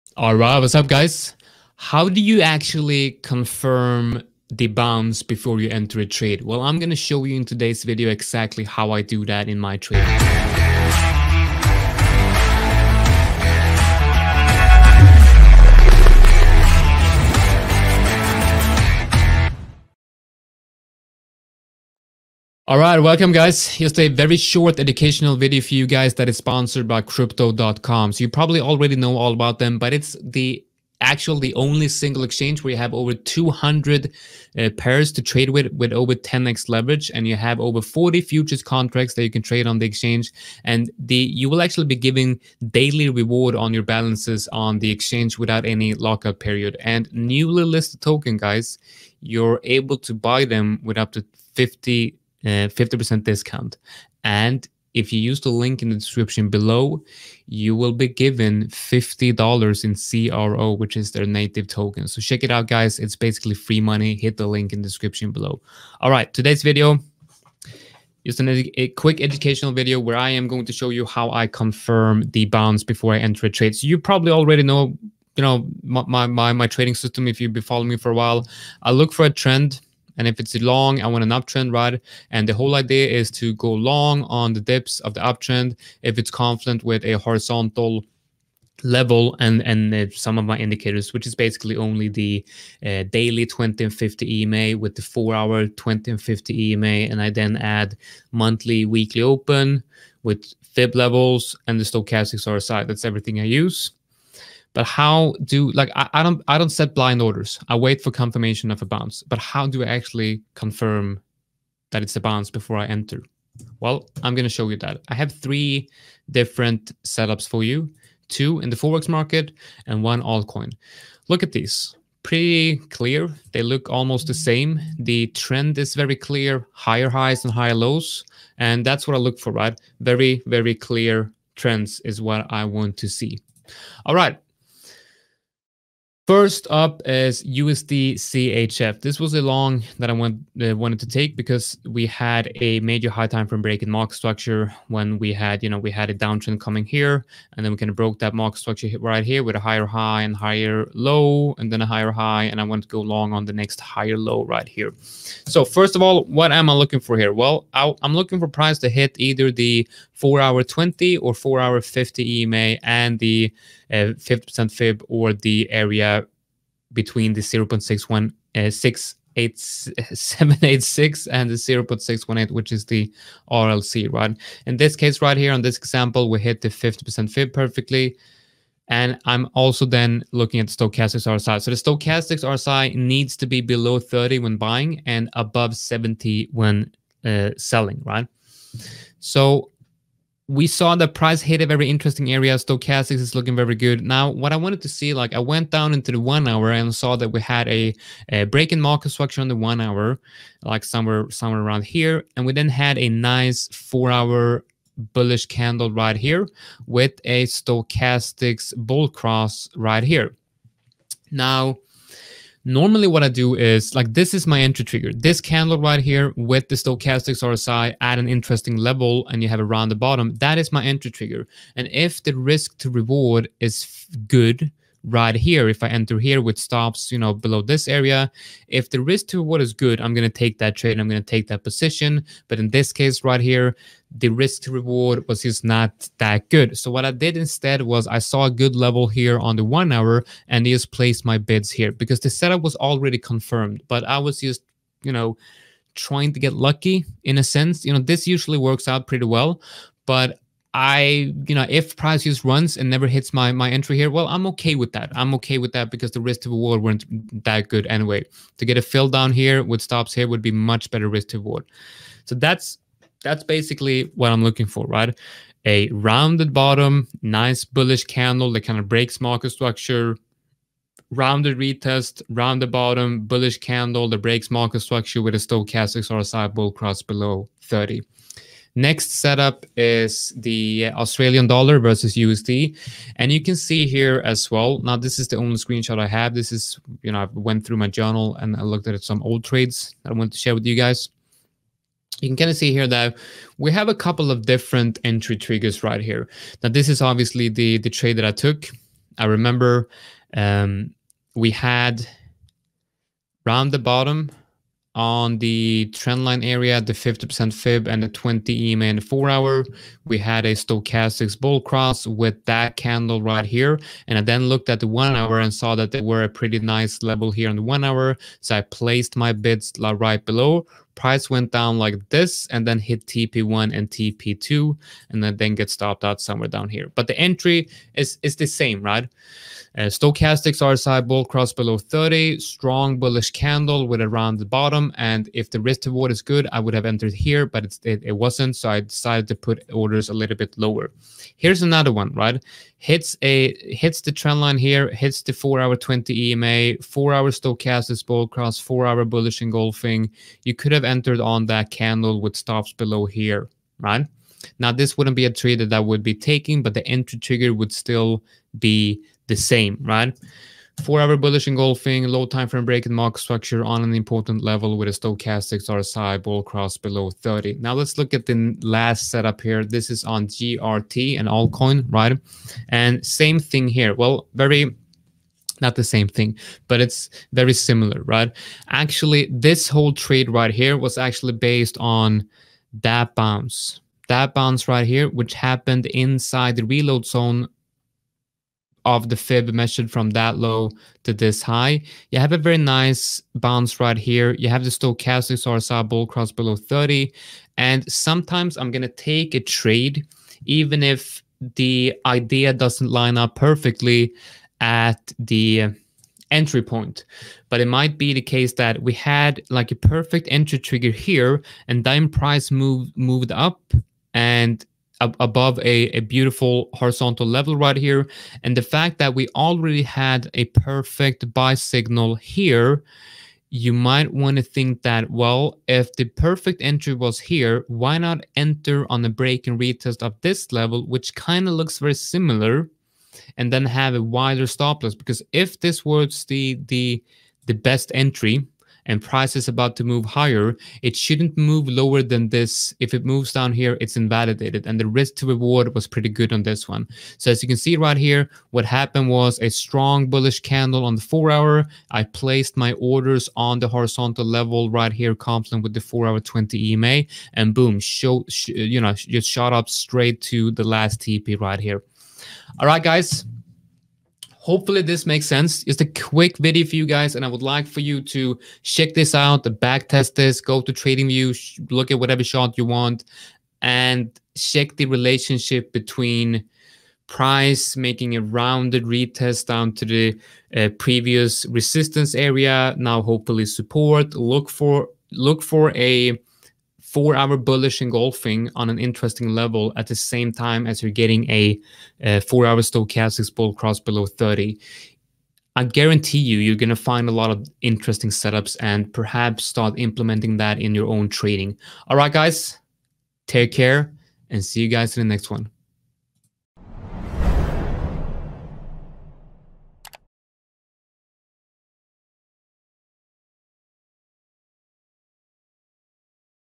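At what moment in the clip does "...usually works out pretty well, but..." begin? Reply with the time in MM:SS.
04:08.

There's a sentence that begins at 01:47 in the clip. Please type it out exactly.
I wait for confirmation of a bounce.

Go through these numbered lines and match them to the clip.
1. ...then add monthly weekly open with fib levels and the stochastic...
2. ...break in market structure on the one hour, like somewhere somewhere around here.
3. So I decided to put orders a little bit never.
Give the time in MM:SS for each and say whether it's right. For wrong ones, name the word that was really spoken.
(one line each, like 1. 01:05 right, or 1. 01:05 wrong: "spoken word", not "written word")
1. 01:37 right
2. 03:18 right
3. 05:38 wrong: "lower", not "never".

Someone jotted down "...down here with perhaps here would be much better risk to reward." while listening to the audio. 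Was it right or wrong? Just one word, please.
wrong.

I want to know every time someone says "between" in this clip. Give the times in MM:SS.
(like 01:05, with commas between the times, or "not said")
02:46, 07:55.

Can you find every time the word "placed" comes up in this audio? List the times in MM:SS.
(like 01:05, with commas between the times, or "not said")
04:00, 05:18, 07:32.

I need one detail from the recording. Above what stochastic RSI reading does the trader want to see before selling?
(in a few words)
70.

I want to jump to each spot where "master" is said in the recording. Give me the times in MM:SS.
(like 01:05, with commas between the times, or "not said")
not said.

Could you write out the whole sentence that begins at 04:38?
Next setup is the Australian dollar versus USD.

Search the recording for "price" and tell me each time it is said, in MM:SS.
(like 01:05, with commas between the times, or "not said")
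02:38, 03:11, 04:11, 05:20, 06:52, 07:18, 07:57.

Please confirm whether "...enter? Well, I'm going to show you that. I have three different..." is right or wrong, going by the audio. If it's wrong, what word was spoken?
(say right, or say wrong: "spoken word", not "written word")
right.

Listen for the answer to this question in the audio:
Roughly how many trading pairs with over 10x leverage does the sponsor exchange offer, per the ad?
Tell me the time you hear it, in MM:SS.
00:32.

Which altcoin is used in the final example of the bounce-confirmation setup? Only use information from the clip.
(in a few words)
GRT.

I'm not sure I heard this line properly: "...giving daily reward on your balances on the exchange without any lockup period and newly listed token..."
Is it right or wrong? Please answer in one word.
right.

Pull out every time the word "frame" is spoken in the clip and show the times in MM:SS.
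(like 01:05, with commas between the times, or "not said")
02:23, 06:02.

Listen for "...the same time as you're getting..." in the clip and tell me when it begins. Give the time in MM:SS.
08:09.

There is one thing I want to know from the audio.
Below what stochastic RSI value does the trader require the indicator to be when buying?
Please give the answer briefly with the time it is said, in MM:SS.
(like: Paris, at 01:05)
30, at 03:03.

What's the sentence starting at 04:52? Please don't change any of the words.
You can kind of see here that we have a couple of different entry triggers right here.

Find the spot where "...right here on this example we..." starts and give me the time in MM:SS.
02:55.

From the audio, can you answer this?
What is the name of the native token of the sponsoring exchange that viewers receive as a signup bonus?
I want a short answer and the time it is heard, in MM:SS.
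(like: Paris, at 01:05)
CRO, at 01:00.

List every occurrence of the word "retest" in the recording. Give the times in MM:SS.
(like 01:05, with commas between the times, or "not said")
04:31, 07:09, 07:58.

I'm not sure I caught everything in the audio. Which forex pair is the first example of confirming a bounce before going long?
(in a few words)
USD CHF.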